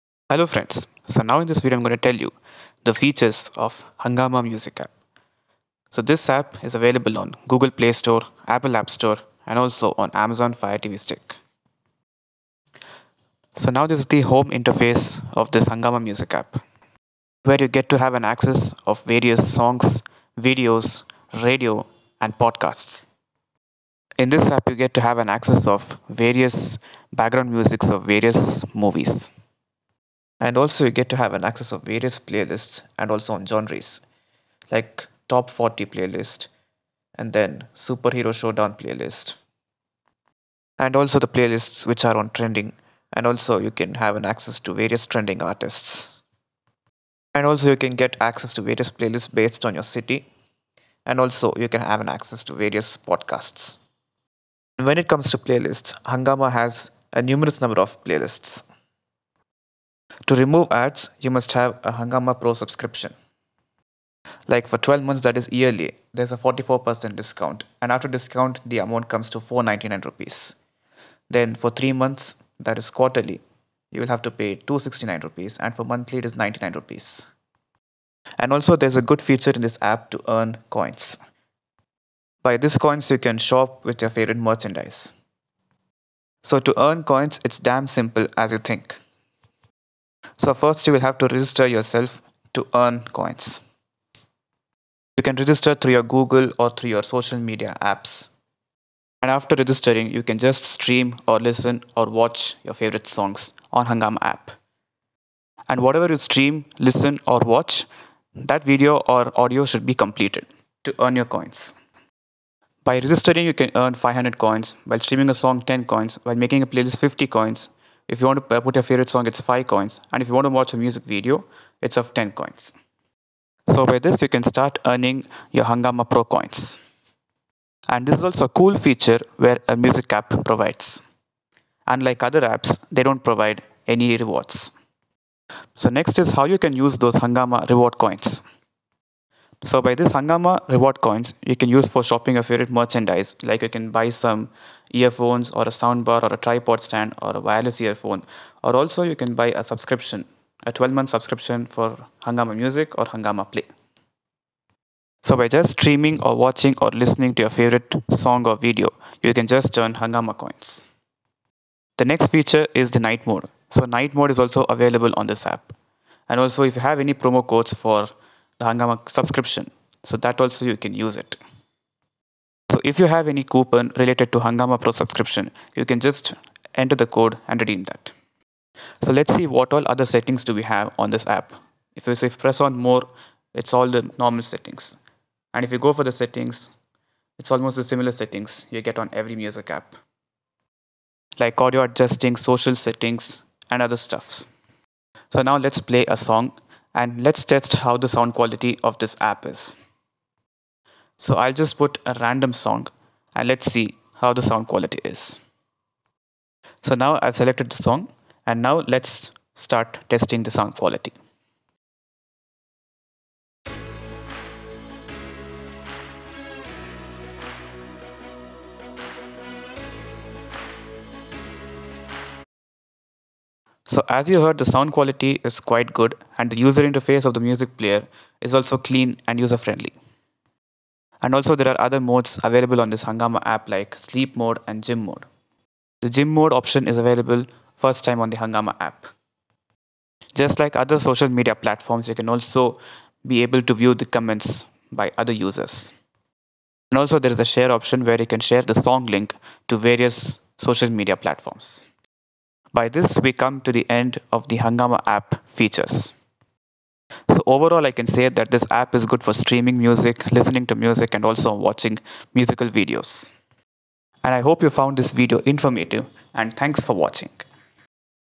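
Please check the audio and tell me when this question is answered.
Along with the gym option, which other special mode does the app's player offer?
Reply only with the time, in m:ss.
3:53.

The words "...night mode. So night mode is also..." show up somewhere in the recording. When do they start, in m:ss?
2:42.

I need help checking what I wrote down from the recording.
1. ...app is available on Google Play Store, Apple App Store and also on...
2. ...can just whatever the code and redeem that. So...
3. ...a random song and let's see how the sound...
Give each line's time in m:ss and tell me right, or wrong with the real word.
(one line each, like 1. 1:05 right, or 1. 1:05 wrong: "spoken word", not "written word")
1. 0:06 right
2. 2:55 wrong: "enter", not "whatever"
3. 3:22 right.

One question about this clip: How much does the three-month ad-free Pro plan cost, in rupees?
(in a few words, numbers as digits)
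269 rupees.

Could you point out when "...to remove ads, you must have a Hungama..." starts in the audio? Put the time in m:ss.
1:00.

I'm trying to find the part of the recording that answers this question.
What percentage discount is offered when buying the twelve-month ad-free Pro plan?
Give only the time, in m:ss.
1:06.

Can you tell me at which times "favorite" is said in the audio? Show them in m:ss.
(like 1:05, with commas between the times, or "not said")
1:24, 1:42, 1:58, 2:22, 2:37.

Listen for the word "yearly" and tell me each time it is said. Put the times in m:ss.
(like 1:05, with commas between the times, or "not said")
1:05.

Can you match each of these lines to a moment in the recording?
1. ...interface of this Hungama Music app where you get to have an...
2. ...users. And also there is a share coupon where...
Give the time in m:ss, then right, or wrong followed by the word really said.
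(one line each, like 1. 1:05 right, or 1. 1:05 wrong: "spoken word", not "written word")
1. 0:14 right
2. 4:05 wrong: "option", not "coupon".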